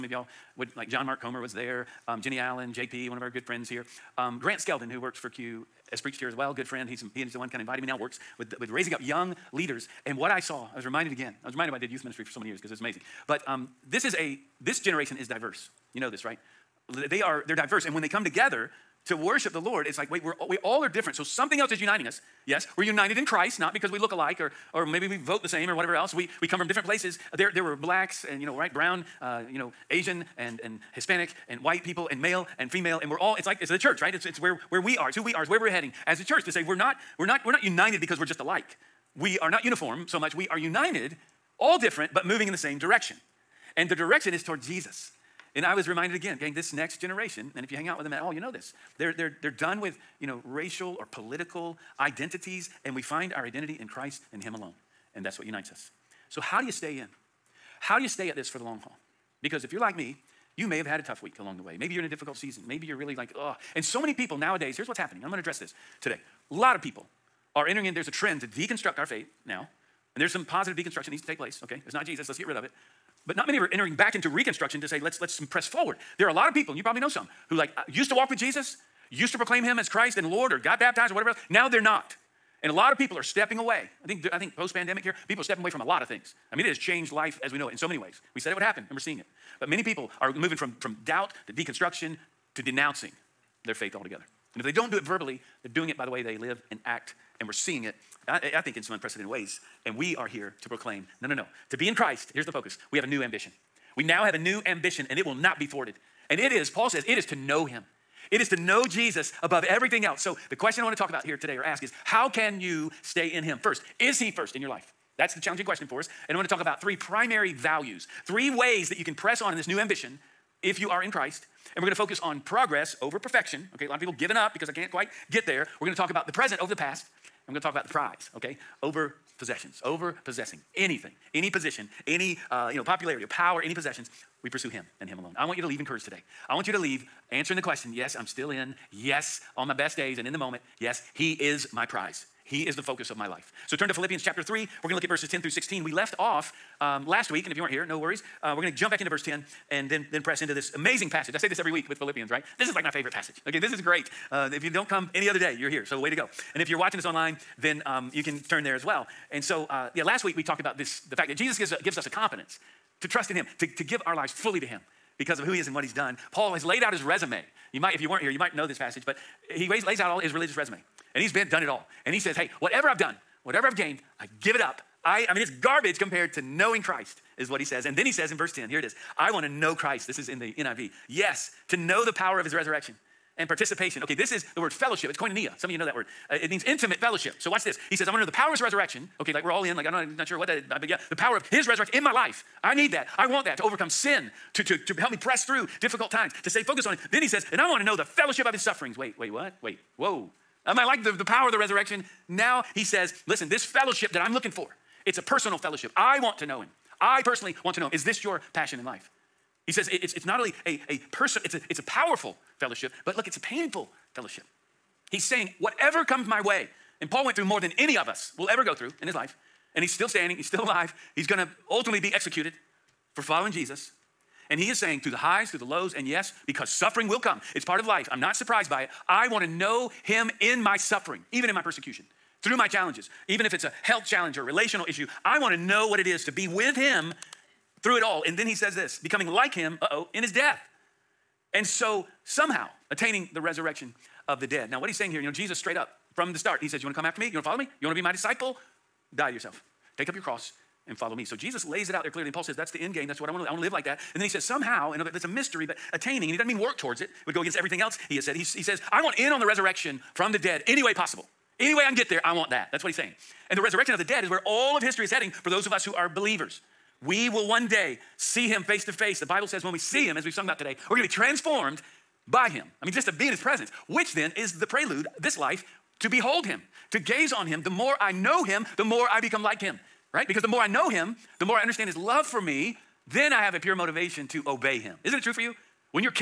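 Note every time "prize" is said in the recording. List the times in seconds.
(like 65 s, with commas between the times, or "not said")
127 s, 141 s.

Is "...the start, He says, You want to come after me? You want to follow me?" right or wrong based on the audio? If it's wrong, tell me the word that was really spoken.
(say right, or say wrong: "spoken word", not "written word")
right.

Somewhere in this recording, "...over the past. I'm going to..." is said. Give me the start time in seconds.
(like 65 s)
126 s.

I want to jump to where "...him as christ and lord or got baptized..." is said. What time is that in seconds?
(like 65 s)
79 s.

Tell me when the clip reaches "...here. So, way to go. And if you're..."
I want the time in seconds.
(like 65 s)
155 s.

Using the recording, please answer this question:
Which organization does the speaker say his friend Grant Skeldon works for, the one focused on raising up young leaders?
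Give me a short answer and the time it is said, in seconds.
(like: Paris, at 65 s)
Q, at 5 s.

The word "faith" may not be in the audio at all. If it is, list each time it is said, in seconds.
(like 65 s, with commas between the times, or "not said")
69 s, 93 s.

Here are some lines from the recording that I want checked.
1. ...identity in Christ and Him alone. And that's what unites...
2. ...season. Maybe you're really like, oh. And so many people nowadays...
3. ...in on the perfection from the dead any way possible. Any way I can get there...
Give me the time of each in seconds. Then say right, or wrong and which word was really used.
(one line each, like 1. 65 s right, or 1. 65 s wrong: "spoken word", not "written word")
1. 53 s right
2. 62 s right
3. 259 s wrong: "resurrection", not "perfection".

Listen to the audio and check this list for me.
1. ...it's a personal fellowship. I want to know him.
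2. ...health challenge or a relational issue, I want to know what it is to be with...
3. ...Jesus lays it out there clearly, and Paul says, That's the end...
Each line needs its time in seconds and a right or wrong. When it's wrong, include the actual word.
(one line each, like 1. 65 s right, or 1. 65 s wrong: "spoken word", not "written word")
1. 205 s right
2. 233 s right
3. 251 s right.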